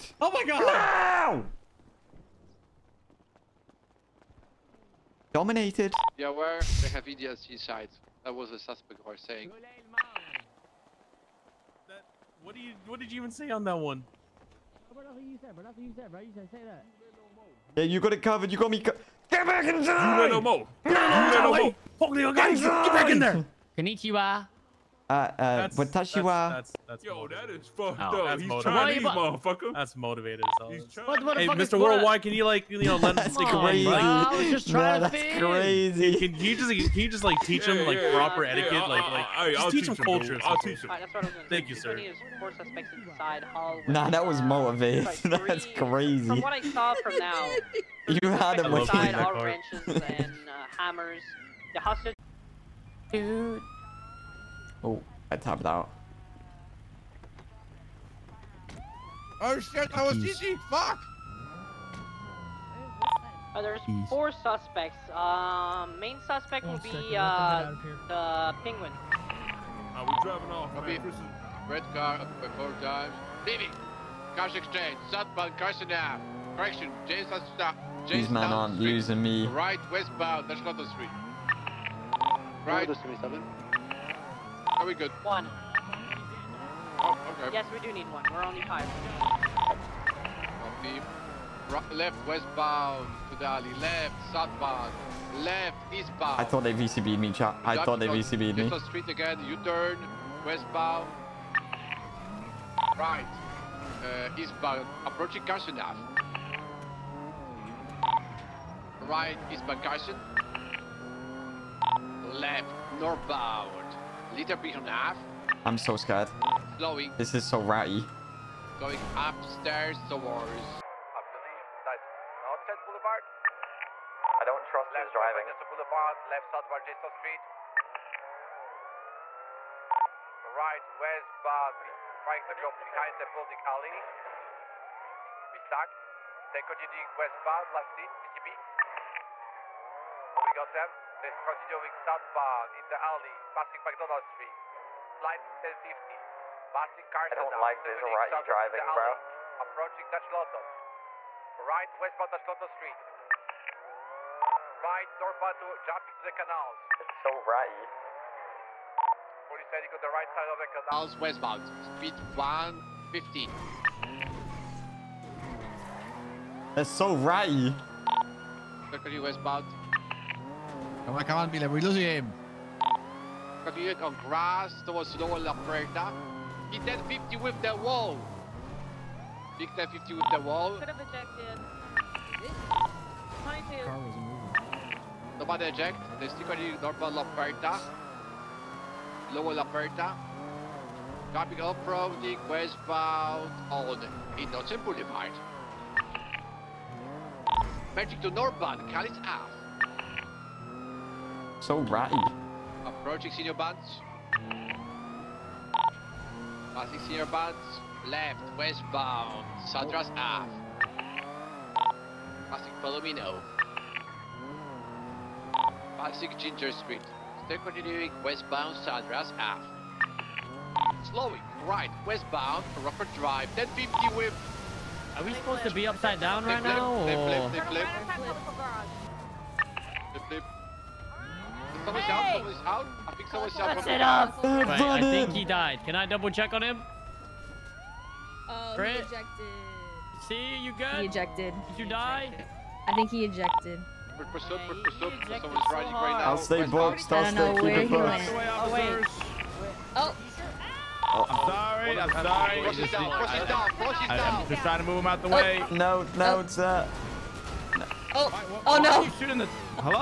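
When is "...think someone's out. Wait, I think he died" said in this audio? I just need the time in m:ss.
3:53.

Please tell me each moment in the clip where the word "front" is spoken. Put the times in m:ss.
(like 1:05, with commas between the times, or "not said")
not said.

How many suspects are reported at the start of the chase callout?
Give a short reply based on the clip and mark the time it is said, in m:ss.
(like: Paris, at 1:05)
4, at 1:04.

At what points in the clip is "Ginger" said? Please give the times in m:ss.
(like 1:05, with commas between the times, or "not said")
3:36.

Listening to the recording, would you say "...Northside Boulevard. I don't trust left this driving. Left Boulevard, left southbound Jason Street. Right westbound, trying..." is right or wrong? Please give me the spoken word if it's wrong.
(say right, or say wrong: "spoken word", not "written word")
right.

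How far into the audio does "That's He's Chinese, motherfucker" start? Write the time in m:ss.
0:28.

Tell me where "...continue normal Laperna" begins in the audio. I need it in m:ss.
3:06.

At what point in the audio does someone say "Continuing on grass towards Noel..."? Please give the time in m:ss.
2:53.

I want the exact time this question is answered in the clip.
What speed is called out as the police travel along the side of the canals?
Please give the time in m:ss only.
2:42.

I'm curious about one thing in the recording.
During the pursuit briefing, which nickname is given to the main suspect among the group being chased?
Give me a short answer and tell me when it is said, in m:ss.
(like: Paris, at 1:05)
the penguin, at 1:08.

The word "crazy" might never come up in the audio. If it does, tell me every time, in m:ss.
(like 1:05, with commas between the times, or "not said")
0:35, 0:45.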